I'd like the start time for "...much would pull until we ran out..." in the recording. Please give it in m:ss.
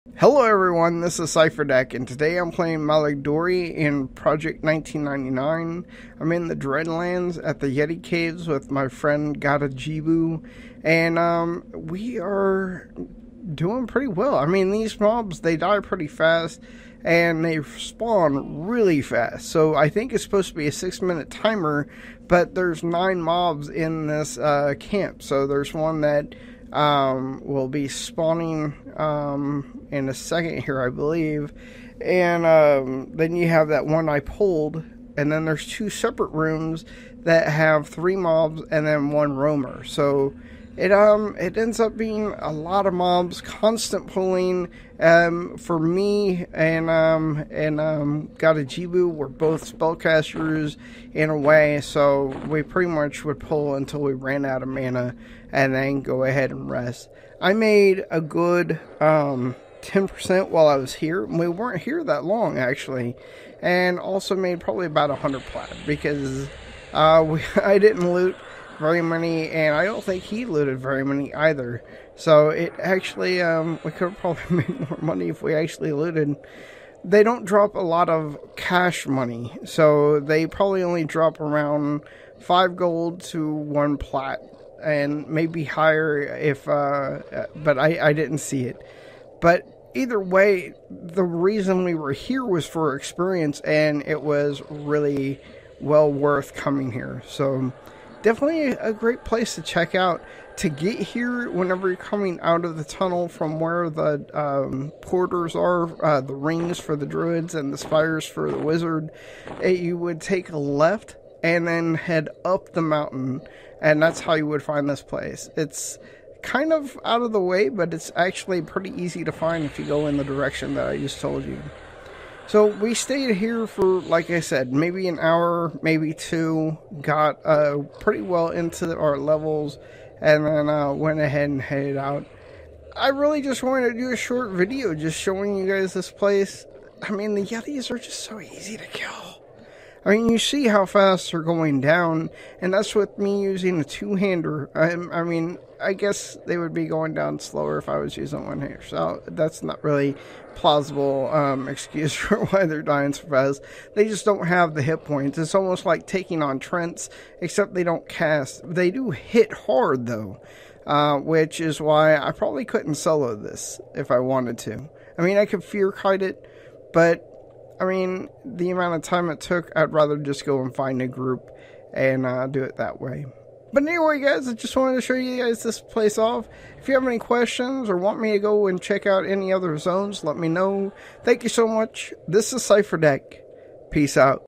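0:52.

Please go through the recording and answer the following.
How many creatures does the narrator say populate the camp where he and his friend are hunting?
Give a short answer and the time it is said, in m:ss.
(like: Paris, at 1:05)
9, at 0:22.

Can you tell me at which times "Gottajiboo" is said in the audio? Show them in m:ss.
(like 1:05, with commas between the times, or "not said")
0:09, 0:48.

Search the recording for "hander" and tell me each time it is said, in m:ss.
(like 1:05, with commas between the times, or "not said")
2:23, 2:28.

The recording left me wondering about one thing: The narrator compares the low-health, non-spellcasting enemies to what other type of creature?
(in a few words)
Trents.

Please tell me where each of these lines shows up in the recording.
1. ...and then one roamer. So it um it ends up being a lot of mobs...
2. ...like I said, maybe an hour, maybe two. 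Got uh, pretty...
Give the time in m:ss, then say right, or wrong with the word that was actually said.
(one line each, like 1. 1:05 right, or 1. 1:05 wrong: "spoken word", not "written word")
1. 0:38 right
2. 2:03 right.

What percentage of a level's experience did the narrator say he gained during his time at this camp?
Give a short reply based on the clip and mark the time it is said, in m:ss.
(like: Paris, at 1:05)
10%, at 0:59.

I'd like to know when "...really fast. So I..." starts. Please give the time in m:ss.
0:18.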